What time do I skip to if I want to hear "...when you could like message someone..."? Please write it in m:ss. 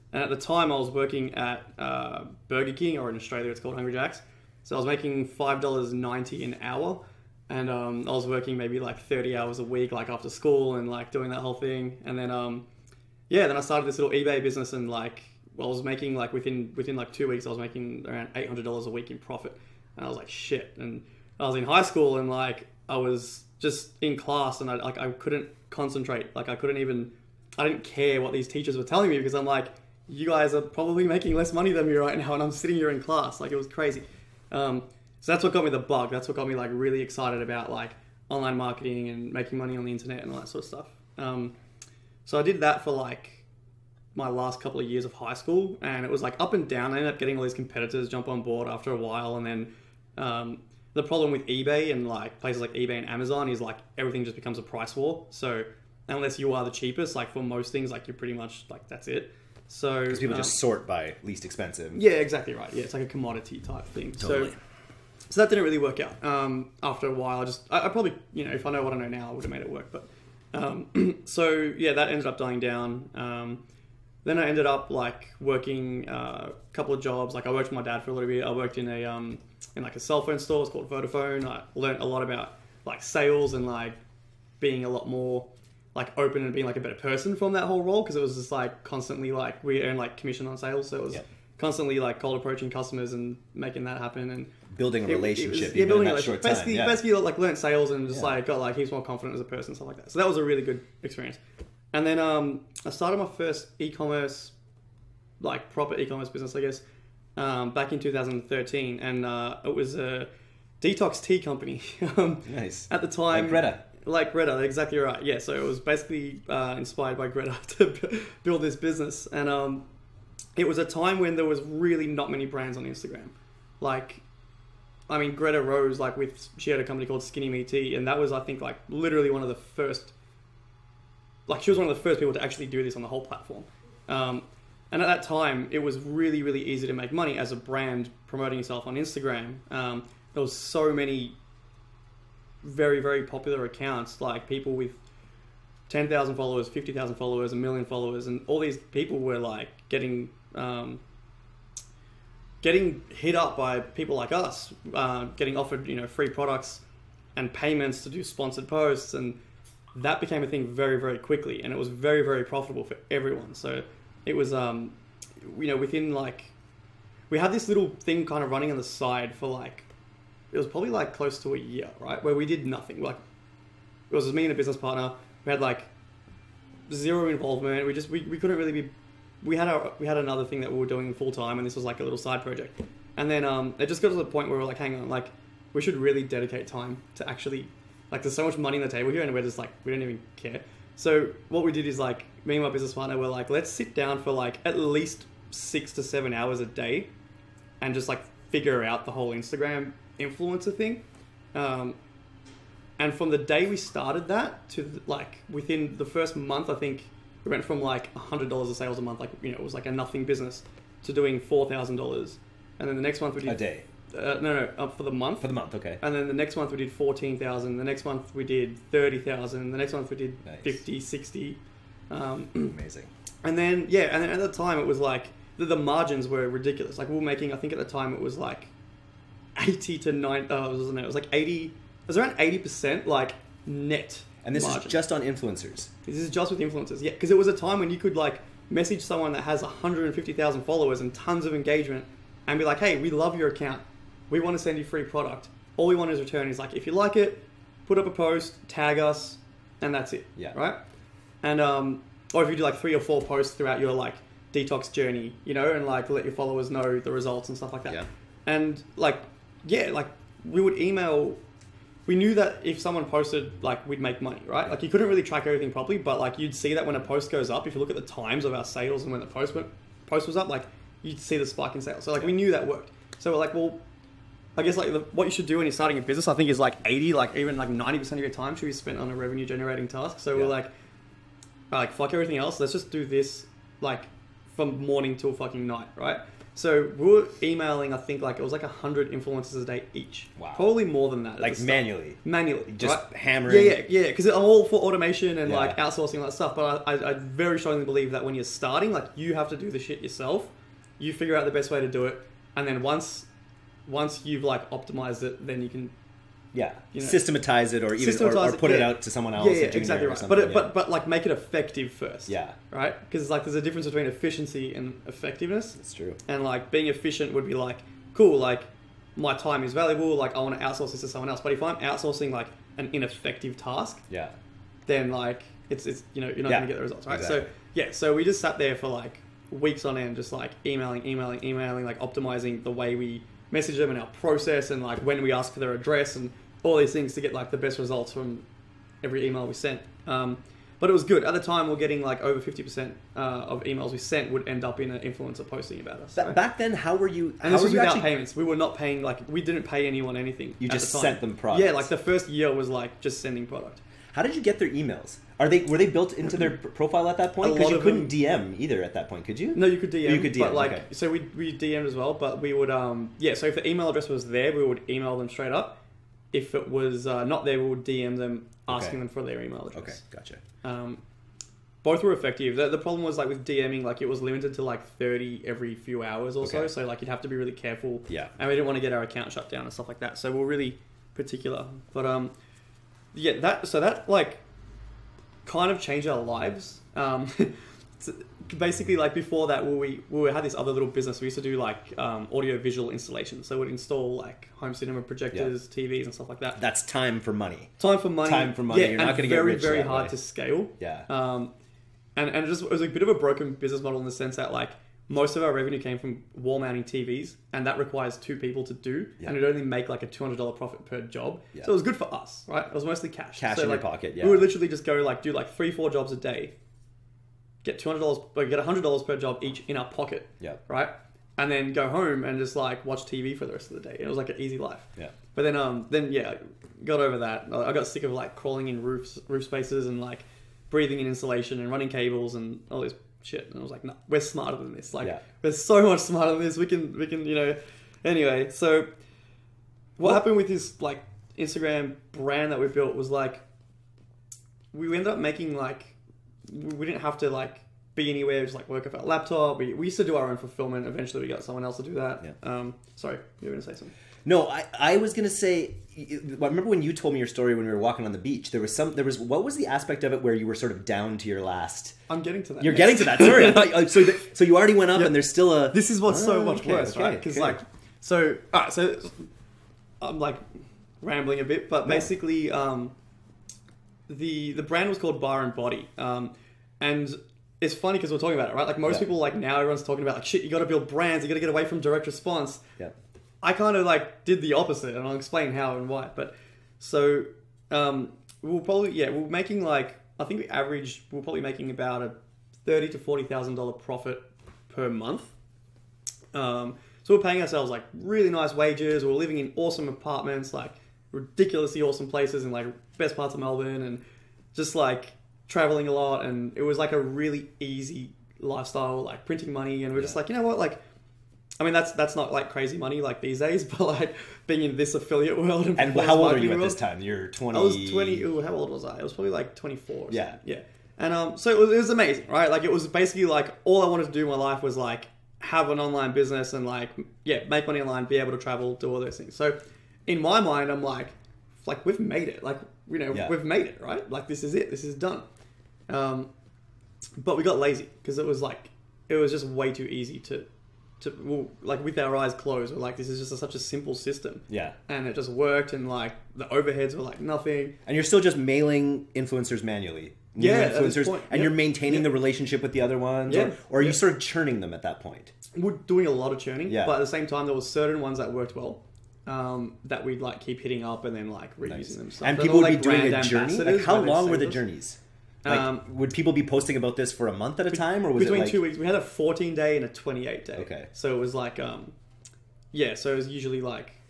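3:57.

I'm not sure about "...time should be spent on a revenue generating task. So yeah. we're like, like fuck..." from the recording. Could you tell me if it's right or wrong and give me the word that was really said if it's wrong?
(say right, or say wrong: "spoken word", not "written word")
right.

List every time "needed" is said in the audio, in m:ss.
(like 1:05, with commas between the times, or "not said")
not said.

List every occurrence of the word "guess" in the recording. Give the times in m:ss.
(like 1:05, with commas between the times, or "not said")
1:46, 4:34.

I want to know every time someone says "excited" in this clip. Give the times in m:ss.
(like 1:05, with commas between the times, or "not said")
0:37.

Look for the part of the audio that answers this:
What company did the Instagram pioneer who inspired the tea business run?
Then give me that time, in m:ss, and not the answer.
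2:07.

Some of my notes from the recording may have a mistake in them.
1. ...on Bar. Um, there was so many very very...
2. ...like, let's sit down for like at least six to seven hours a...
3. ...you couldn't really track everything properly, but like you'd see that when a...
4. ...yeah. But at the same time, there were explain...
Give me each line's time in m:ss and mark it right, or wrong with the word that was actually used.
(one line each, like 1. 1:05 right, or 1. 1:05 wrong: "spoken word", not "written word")
1. 2:18 wrong: "Instagram", not "Bar"
2. 3:13 right
3. 4:24 right
4. 9:16 wrong: "certain", not "explain".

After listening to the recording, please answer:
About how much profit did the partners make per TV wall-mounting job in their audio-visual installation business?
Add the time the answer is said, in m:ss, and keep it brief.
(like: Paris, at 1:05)
$200, at 6:50.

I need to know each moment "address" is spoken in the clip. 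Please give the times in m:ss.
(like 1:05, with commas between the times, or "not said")
5:35, 6:03, 6:09.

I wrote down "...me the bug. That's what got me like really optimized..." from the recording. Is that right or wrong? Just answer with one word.
wrong.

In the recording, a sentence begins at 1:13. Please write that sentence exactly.
Um, then I ended up like working uh, a couple of jobs.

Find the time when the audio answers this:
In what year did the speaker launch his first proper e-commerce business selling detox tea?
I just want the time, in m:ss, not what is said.
1:48.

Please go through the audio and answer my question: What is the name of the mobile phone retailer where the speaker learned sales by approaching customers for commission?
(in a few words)
Vodafone.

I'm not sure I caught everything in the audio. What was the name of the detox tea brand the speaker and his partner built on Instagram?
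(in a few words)
Bar and Body.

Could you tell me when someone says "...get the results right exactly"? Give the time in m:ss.
5:26.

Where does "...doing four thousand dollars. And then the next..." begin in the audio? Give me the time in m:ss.
3:31.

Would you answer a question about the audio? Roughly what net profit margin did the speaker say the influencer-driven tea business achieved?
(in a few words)
80%.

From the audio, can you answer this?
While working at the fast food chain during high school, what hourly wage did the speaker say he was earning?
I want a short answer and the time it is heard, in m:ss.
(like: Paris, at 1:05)
$5.90, at 0:05.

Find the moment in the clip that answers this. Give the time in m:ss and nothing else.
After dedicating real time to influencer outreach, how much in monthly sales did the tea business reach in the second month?
3:36.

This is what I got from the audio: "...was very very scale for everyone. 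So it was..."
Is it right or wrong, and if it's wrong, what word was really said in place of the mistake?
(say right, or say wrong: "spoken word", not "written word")
wrong: "profitable", not "scale".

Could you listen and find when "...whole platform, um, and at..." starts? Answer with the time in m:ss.
2:13.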